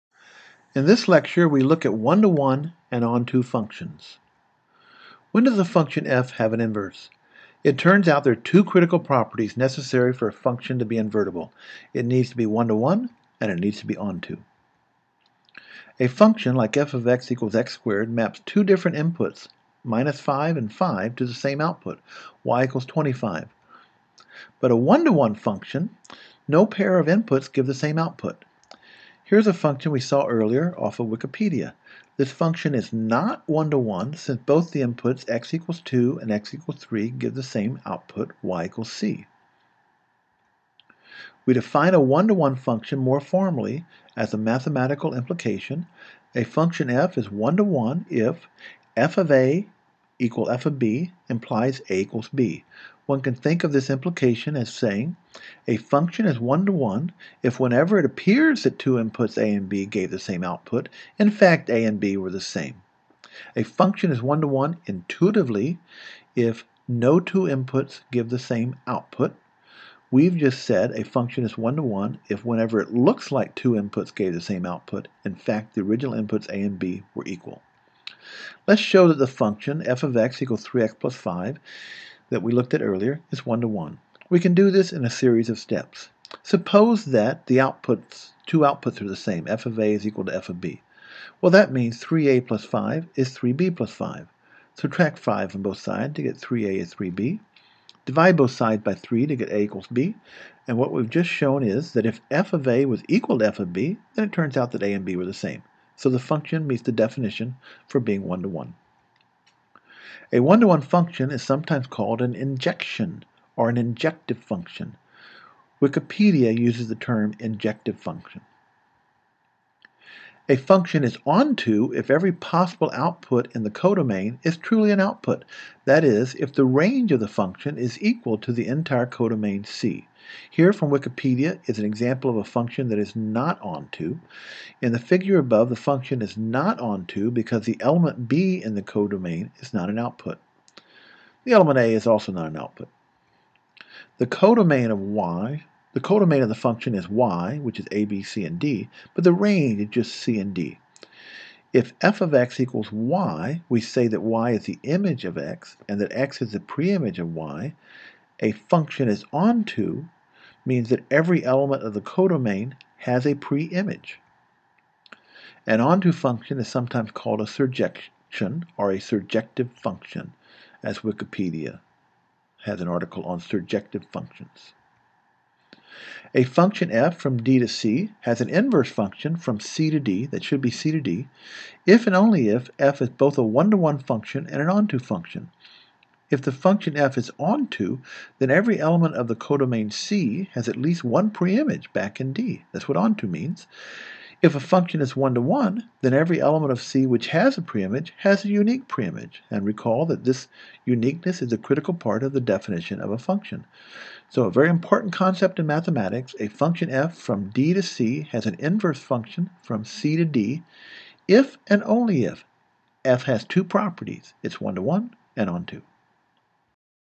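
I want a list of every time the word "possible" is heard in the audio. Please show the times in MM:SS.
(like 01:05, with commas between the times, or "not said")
02:02.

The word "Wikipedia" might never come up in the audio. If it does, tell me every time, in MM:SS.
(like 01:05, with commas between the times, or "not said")
00:31, 01:55, 02:10, 02:51.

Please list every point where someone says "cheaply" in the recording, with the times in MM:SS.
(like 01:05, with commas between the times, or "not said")
not said.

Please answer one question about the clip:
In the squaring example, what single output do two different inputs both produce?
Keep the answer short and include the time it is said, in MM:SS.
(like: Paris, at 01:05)
25, at 00:22.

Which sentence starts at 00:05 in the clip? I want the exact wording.
When does a function f have an inverse?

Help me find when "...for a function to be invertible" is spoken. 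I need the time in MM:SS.
00:10.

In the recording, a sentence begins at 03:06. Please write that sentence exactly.
If the function f is onto, then every element of the codomain C has at least one preimage back in D.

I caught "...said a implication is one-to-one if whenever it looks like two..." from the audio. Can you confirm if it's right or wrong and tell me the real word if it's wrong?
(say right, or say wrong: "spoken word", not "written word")
wrong: "function", not "implication".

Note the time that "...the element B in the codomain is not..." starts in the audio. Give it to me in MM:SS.
02:17.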